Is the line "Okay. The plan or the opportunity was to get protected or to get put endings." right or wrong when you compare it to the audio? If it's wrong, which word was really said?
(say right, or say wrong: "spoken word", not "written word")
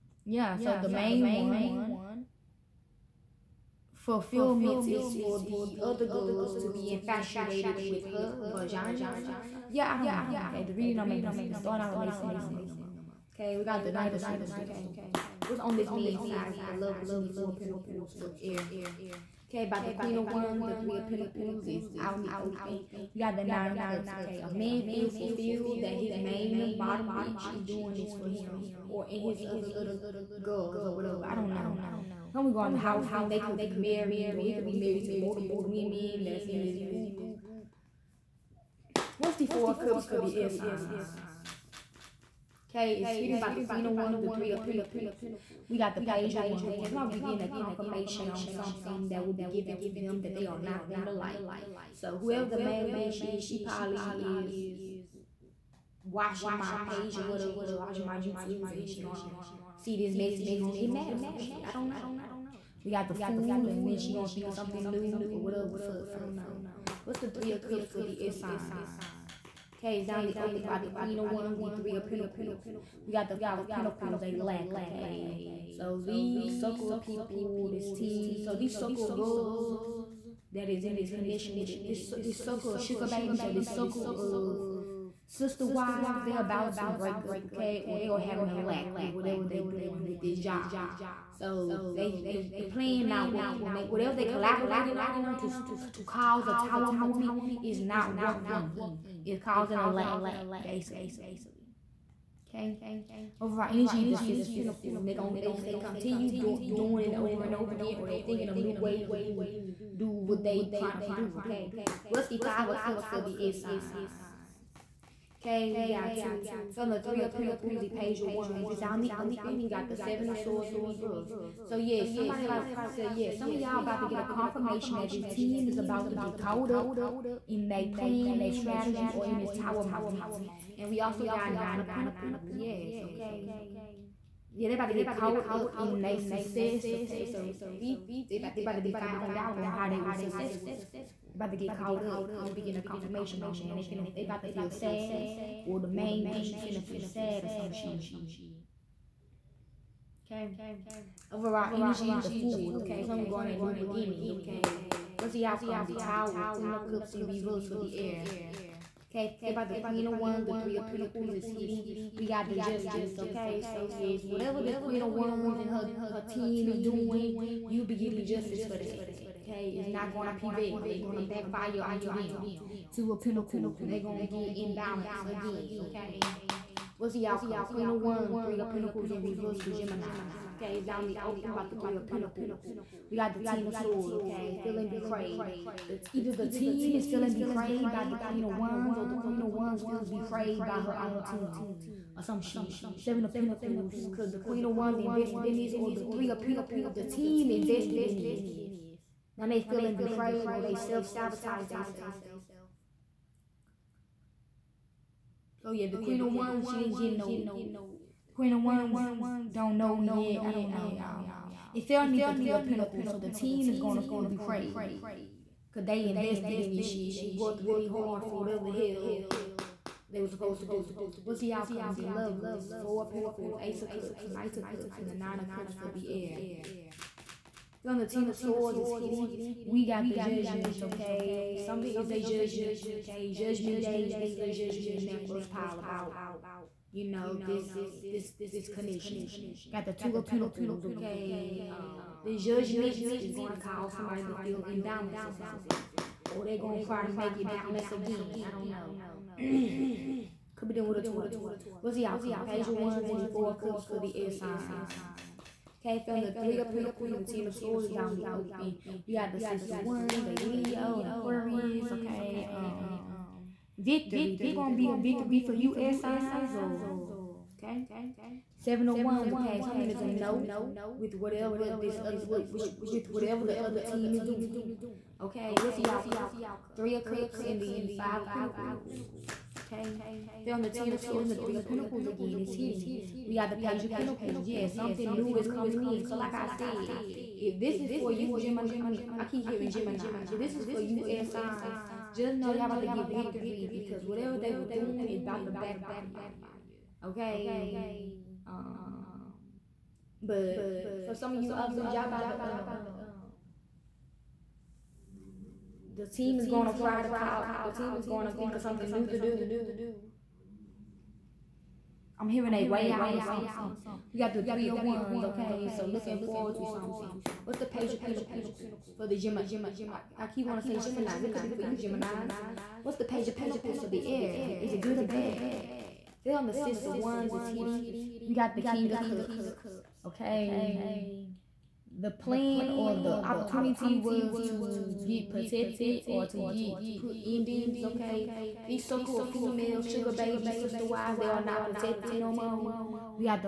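right.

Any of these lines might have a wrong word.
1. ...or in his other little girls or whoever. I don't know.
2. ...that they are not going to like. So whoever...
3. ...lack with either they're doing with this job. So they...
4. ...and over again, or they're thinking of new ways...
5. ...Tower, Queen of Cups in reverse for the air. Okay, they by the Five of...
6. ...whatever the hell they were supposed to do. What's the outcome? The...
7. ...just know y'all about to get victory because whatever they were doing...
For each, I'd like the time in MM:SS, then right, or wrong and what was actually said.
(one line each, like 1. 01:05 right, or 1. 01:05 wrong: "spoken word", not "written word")
1. 00:28 wrong: "whatever", not "whoever"
2. 00:50 right
3. 01:28 wrong: "whatever", not "either"
4. 01:47 right
5. 02:35 wrong: "Queen", not "Five"
6. 03:38 right
7. 04:52 right.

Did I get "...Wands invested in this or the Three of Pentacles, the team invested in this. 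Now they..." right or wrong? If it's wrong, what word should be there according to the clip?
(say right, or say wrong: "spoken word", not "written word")
right.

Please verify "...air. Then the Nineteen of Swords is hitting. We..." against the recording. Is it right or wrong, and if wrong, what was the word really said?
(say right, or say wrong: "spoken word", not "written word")
wrong: "Ten", not "Nineteen".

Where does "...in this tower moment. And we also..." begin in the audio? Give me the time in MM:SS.
02:09.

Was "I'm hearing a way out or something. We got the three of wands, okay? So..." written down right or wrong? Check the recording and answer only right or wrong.
right.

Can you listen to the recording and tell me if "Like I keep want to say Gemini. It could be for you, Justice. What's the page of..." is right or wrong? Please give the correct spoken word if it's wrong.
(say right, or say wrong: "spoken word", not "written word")
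wrong: "Geminis", not "Justice".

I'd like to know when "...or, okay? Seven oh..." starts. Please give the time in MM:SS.
04:26.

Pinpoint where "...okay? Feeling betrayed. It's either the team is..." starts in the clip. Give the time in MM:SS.
03:04.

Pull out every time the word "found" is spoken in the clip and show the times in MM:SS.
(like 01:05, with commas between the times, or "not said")
02:18, 04:16.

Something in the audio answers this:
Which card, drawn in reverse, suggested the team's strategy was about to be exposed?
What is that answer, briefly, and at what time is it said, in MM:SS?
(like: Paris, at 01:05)
Seven of Swords, at 01:59.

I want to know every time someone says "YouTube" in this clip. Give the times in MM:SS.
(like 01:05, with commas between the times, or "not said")
00:58.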